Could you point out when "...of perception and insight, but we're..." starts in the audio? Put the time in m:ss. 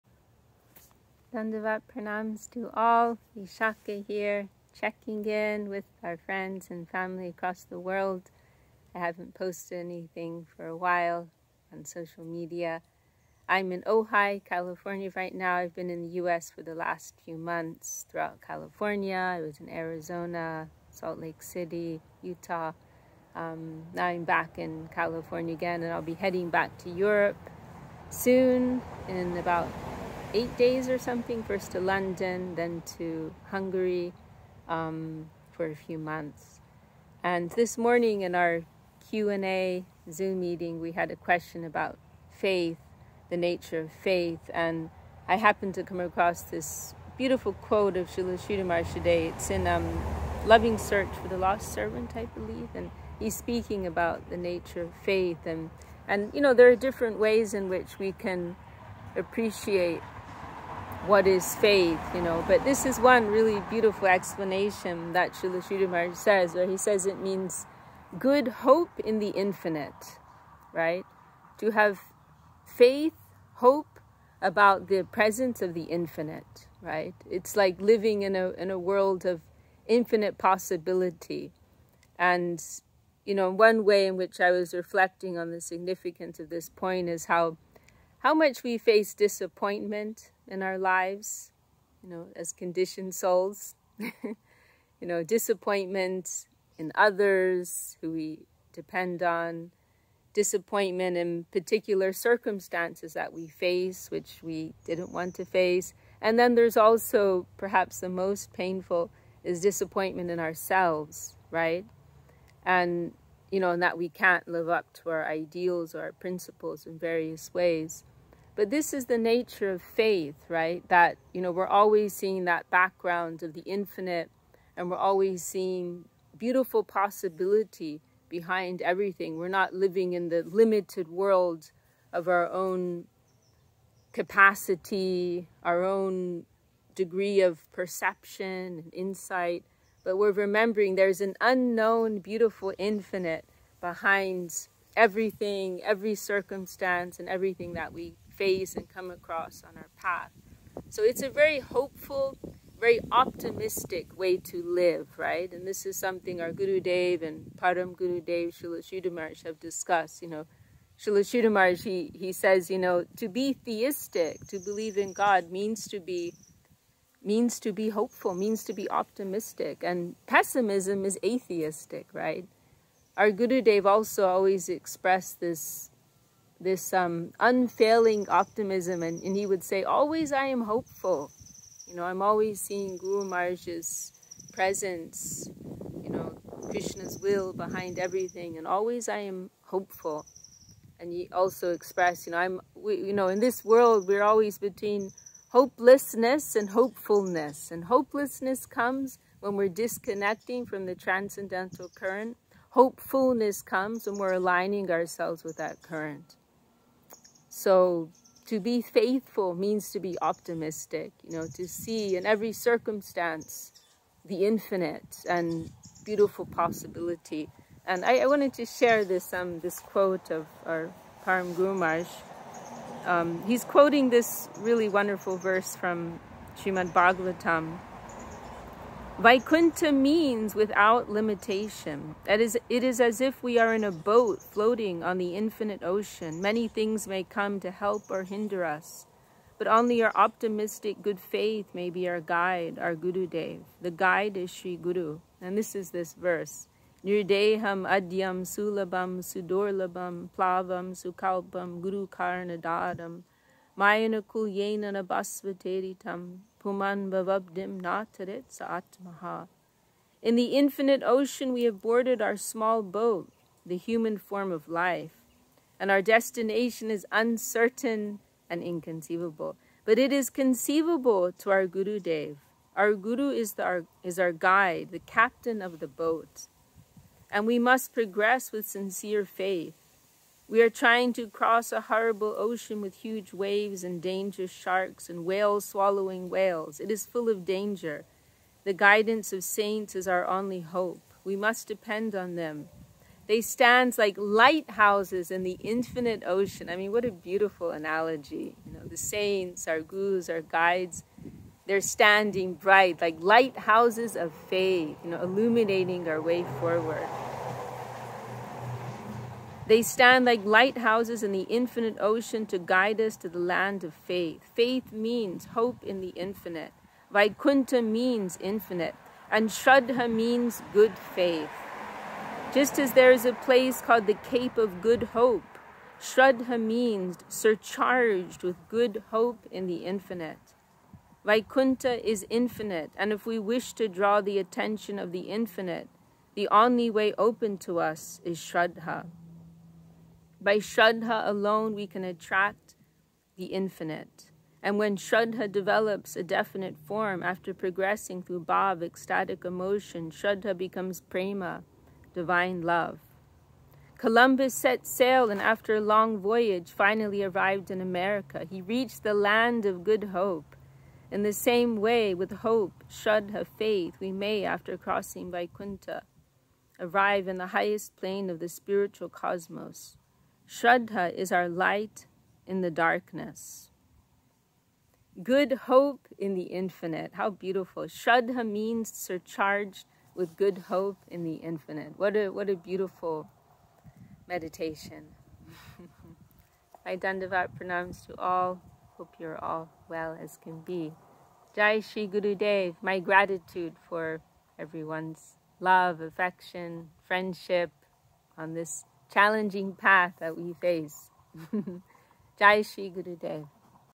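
2:17.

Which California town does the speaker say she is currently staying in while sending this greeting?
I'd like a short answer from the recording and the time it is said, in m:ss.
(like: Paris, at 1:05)
Ojai, at 0:13.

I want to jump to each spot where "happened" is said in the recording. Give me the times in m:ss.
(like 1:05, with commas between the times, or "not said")
0:45.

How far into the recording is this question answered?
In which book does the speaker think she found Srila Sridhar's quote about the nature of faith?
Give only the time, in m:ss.
0:50.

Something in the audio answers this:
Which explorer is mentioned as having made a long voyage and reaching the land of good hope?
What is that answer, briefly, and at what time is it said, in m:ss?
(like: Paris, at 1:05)
Columbus, at 5:53.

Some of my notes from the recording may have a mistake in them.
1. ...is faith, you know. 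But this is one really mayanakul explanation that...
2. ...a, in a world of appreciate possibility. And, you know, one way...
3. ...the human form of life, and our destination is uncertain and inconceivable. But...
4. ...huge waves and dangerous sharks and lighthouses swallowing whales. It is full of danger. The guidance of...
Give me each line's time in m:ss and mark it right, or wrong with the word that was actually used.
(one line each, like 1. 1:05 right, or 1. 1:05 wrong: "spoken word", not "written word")
1. 1:01 wrong: "beautiful", not "mayanakul"
2. 1:18 wrong: "infinite", not "appreciate"
3. 4:23 right
4. 4:43 wrong: "whales", not "lighthouses".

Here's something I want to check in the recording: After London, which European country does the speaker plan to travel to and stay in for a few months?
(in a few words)
Hungary.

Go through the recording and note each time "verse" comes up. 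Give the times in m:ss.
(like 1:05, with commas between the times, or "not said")
3:45, 4:06.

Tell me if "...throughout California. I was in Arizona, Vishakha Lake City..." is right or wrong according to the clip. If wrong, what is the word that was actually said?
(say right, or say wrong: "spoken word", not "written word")
wrong: "Salt", not "Vishakha".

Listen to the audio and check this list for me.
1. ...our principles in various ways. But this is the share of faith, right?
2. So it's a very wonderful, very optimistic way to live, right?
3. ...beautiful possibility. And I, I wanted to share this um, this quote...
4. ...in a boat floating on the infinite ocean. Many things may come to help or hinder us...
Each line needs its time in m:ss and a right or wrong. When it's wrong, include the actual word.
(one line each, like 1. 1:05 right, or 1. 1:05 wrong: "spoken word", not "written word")
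1. 1:56 wrong: "nature", not "share"
2. 2:30 wrong: "hopeful", not "wonderful"
3. 3:36 right
4. 3:53 right.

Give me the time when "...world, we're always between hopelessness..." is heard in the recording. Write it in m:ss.
3:13.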